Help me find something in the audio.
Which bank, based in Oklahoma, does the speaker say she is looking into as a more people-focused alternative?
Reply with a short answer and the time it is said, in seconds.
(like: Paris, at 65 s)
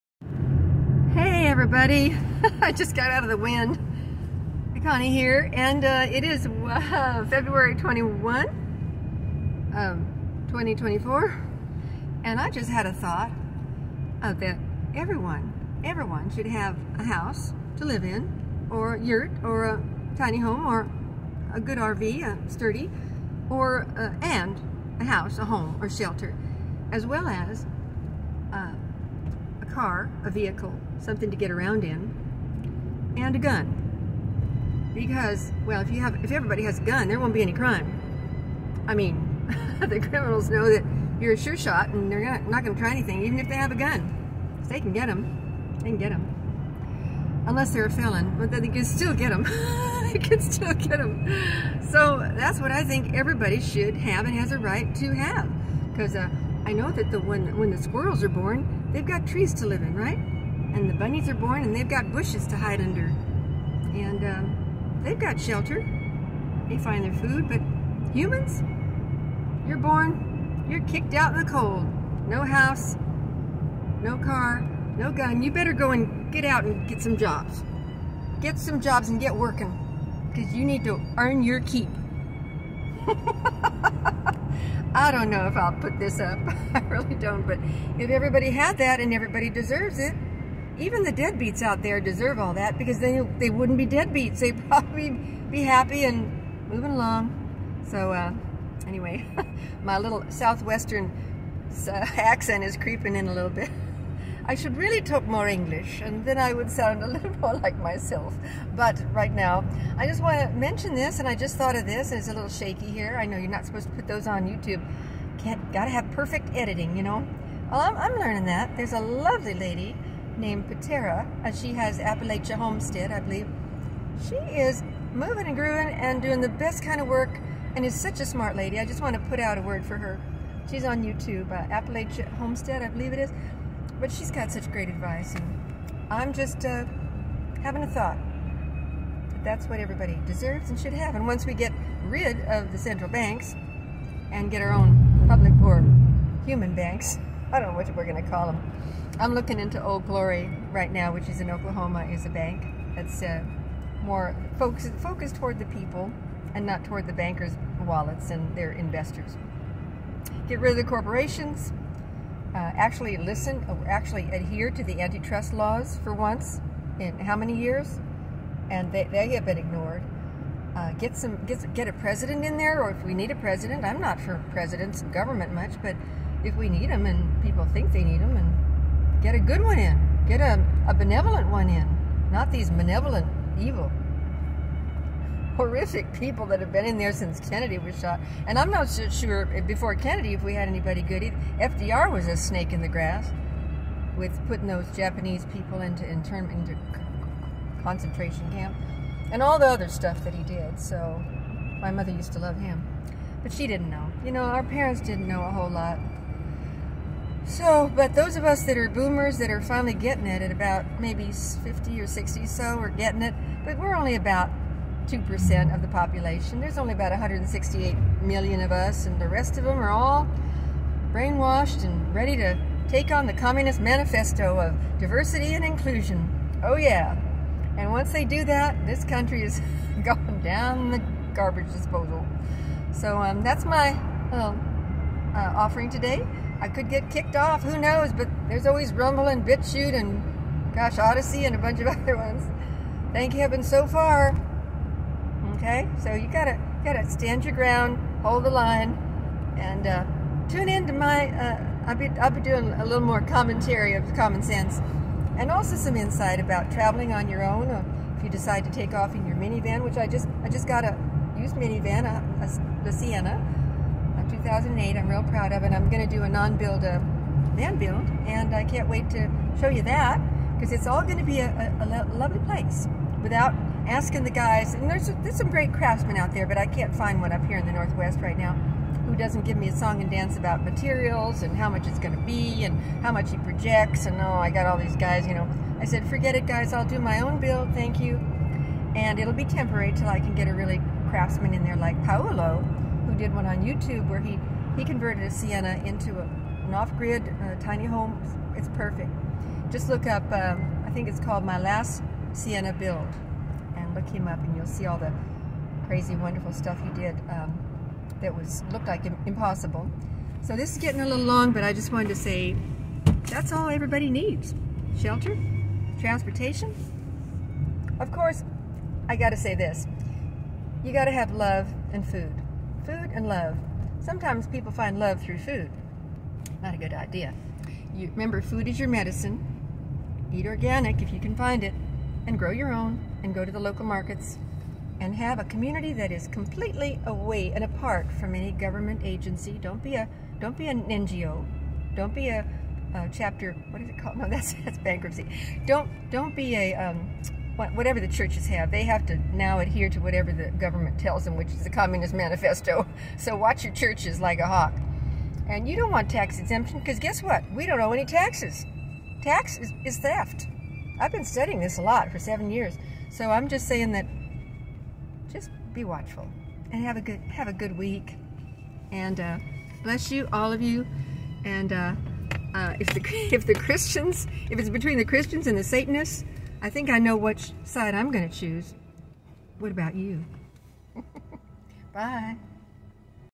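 Old Glory, at 149 s.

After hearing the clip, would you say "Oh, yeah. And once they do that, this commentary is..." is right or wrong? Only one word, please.
wrong.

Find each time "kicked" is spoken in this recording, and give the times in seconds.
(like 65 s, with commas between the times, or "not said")
70 s, 237 s.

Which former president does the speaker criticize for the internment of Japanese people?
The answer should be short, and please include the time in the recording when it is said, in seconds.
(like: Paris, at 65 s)
FDR, at 191 s.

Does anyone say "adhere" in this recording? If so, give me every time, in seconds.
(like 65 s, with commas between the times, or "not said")
164 s, 349 s.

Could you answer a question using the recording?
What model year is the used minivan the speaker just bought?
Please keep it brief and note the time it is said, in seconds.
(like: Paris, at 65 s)
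2008, at 264 s.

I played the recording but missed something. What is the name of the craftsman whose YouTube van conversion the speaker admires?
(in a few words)
Paolo.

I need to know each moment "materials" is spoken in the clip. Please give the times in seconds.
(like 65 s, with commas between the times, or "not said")
280 s.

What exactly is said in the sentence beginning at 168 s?
And they, they have been ignored.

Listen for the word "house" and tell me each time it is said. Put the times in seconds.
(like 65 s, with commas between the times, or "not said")
17 s, 25 s, 72 s.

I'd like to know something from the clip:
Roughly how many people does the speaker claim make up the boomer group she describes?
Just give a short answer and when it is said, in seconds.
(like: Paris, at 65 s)
168 million, at 217 s.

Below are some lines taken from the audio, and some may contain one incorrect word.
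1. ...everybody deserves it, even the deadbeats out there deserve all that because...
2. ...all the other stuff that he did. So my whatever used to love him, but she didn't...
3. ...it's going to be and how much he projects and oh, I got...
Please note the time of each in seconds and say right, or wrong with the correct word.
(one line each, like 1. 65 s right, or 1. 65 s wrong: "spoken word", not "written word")
1. 89 s right
2. 199 s wrong: "mother", not "whatever"
3. 281 s right.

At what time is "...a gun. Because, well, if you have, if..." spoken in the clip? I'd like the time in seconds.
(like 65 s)
33 s.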